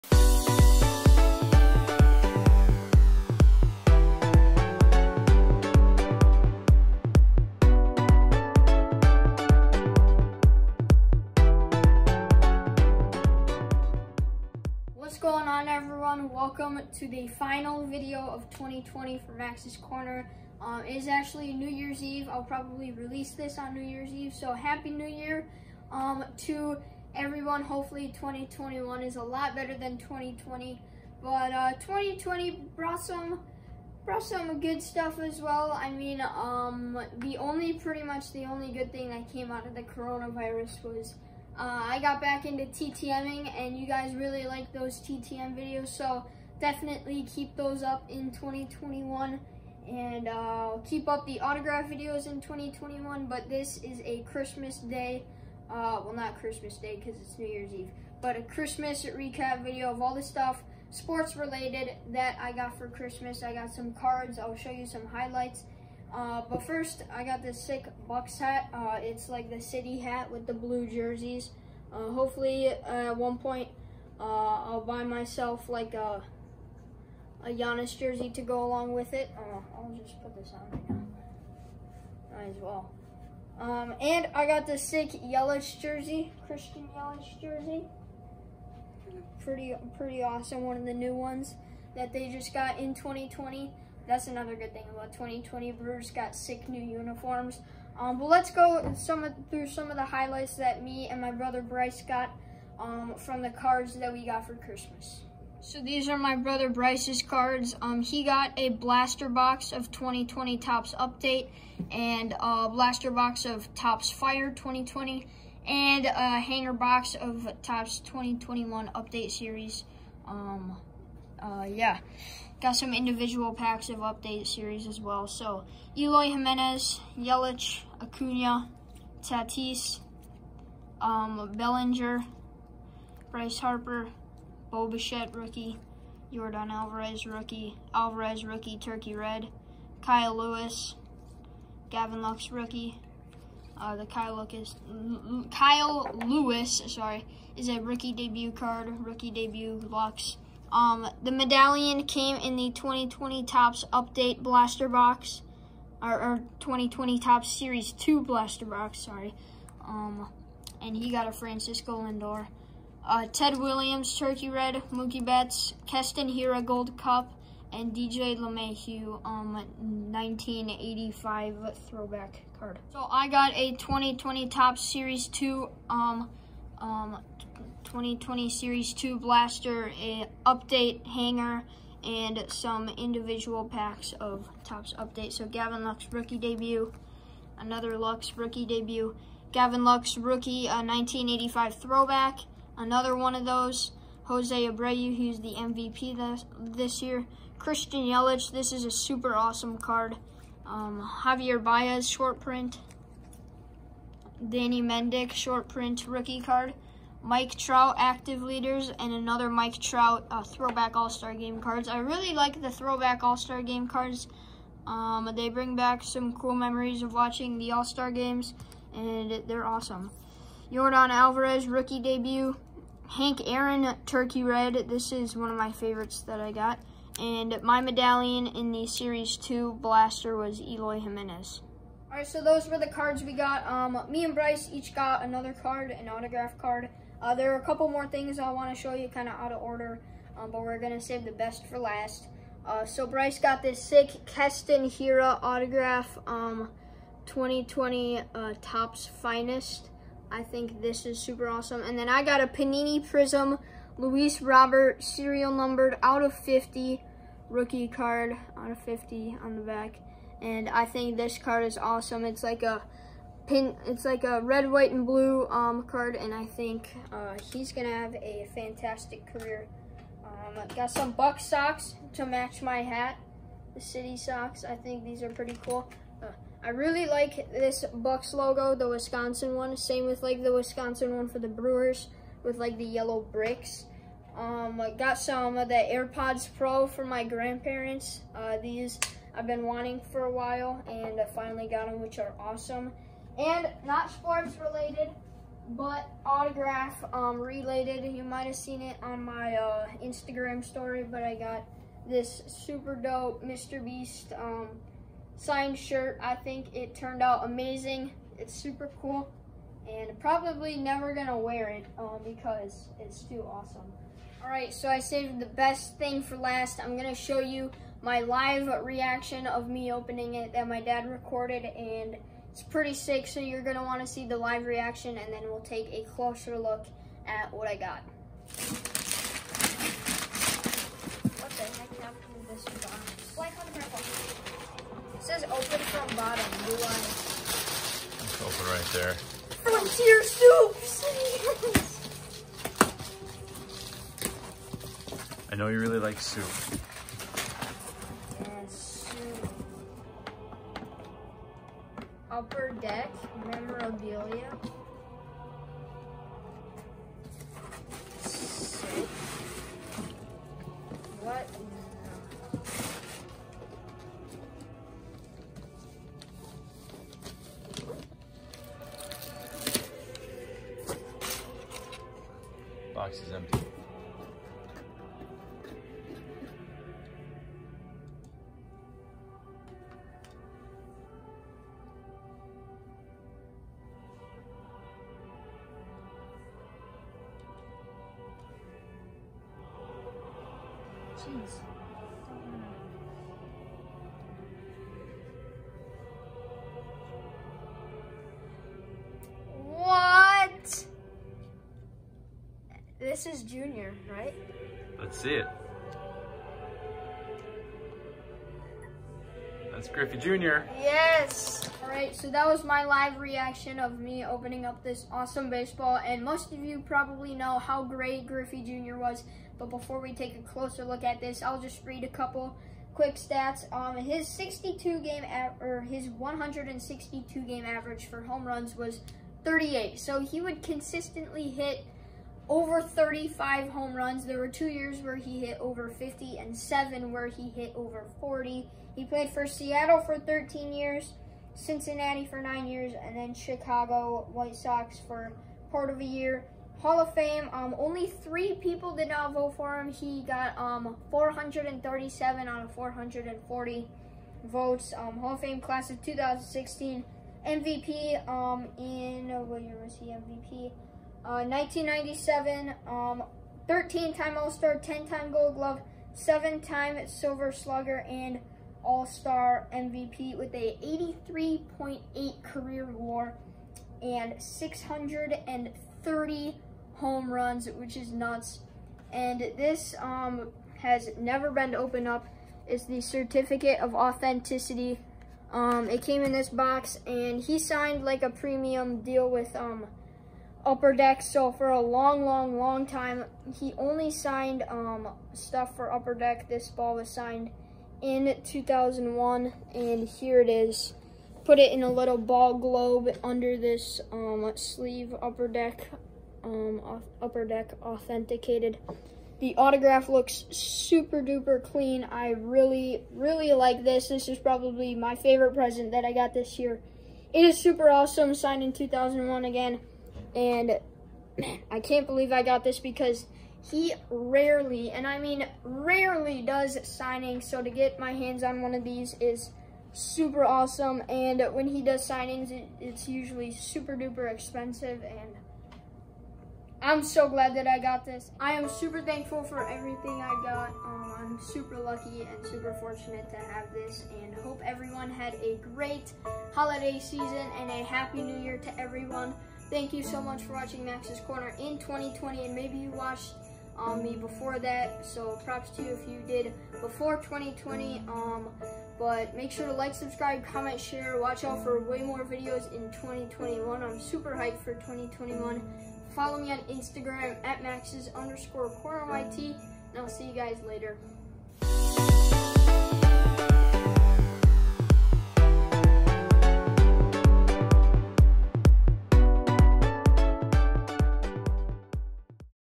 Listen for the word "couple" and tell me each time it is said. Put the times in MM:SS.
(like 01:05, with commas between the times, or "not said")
03:57, 07:02.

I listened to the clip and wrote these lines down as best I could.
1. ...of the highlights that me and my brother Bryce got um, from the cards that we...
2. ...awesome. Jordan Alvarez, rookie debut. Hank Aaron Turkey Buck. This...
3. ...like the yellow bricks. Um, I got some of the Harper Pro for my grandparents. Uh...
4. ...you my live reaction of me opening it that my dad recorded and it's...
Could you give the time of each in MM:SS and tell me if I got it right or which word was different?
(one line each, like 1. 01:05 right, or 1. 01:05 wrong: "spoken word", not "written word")
1. 01:39 right
2. 03:39 wrong: "Red", not "Buck"
3. 04:42 wrong: "AirPods", not "Harper"
4. 05:17 right.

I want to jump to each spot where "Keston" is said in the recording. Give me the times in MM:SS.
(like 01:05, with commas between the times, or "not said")
02:45, 04:04.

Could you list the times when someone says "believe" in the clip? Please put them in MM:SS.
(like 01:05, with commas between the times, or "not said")
08:42.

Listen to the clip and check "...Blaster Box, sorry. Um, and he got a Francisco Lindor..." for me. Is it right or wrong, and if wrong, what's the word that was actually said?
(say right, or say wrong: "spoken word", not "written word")
right.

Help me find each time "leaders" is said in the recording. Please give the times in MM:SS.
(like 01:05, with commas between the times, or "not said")
03:28.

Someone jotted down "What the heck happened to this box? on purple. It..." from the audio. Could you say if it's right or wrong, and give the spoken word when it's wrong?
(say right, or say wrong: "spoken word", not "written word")
right.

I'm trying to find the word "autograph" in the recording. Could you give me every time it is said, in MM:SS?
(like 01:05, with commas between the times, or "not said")
00:51, 03:56, 04:05, 04:56, 08:29.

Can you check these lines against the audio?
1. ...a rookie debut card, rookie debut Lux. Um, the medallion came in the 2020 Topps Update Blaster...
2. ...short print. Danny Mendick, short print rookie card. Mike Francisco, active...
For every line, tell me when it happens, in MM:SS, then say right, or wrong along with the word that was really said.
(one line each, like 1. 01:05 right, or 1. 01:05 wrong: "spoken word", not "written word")
1. 02:27 right
2. 03:22 wrong: "Trout", not "Francisco".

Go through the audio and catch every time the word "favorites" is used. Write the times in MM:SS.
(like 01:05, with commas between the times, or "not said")
03:45, 08:35.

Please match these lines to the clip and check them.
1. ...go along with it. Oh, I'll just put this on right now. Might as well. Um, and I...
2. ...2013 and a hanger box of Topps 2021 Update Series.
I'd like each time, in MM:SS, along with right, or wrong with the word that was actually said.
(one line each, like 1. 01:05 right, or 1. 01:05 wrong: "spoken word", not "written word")
1. 01:18 right
2. 01:54 wrong: "2020", not "2013".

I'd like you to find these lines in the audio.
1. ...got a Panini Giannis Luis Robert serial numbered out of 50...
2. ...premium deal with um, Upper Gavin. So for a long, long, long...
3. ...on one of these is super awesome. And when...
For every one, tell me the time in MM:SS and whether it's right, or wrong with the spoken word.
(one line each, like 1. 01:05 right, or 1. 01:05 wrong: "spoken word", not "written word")
1. 04:12 wrong: "Prism", not "Giannis"
2. 08:08 wrong: "Deck", not "Gavin"
3. 08:48 right.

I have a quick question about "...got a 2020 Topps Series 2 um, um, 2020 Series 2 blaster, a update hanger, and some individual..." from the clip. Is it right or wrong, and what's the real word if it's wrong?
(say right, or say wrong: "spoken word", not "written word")
right.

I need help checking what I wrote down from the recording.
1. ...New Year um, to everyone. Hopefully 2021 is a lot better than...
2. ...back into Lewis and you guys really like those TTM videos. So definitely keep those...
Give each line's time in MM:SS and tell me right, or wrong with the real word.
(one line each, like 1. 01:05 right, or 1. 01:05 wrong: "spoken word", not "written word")
1. 00:24 right
2. 00:42 wrong: "TTMing", not "Lewis".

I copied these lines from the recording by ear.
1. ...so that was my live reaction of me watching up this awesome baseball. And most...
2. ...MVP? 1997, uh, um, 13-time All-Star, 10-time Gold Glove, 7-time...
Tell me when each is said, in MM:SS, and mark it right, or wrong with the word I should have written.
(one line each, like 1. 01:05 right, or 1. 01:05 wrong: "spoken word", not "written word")
1. 06:52 wrong: "opening", not "watching"
2. 07:40 right.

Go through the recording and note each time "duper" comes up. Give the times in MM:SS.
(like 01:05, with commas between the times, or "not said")
08:31, 08:53.